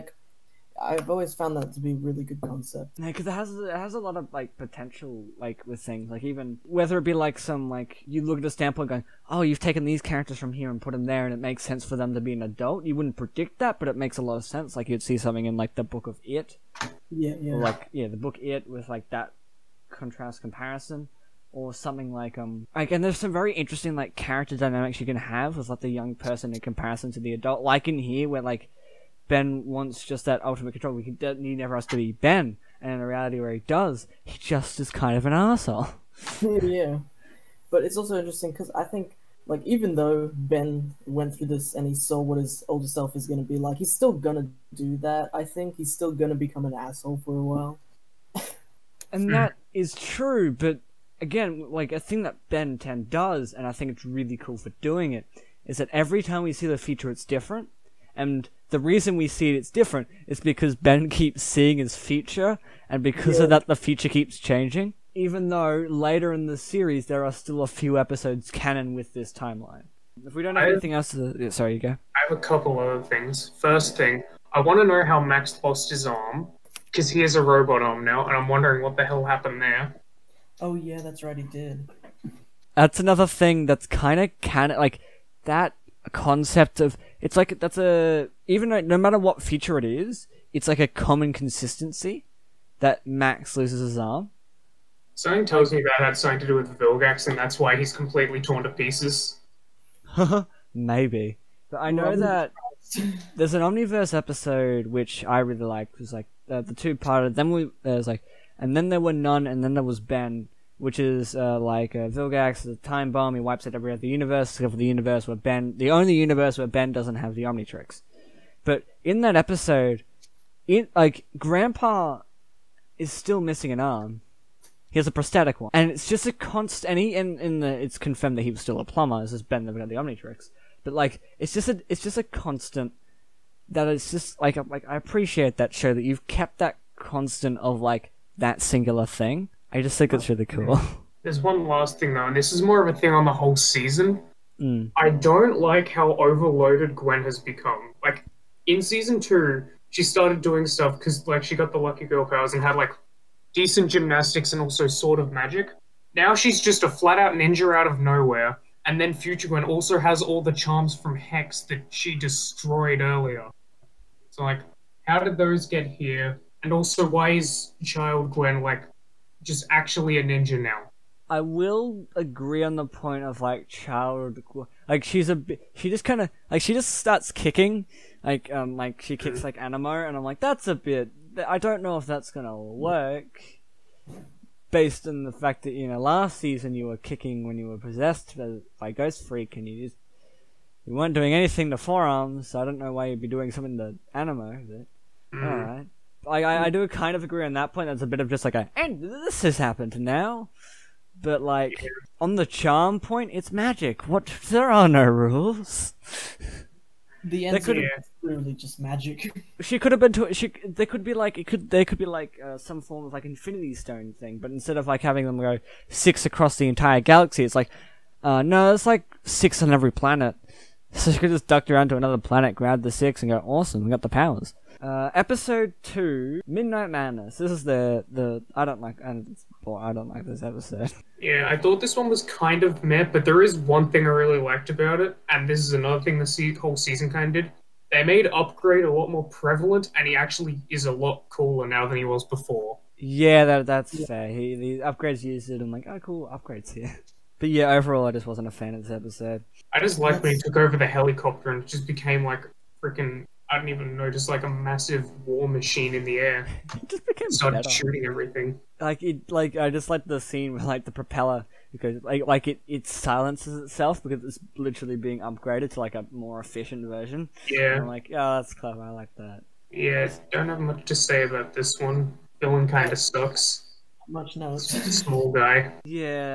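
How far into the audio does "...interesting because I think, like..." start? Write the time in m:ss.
0:38.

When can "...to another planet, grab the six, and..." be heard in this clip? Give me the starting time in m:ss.
3:41.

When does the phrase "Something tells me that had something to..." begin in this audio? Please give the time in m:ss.
1:35.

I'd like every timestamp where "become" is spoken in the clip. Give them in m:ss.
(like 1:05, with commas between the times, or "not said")
0:46, 2:27.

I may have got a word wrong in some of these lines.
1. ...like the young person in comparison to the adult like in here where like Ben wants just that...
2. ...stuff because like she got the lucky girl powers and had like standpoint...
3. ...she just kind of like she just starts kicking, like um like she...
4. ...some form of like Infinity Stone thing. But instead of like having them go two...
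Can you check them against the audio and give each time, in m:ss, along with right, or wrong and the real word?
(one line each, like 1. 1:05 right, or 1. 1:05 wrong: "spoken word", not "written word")
1. 0:25 right
2. 2:30 wrong: "decent", not "standpoint"
3. 2:55 right
4. 3:32 wrong: "six", not "two".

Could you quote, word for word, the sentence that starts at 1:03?
of that, the future keeps changing.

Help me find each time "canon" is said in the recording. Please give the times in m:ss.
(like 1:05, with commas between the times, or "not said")
1:08, 1:24.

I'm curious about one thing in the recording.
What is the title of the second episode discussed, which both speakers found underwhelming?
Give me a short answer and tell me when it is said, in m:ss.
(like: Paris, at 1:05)
Midnight Madness, at 3:46.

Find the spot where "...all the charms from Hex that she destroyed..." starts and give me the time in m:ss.
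2:40.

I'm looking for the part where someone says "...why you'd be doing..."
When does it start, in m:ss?
3:12.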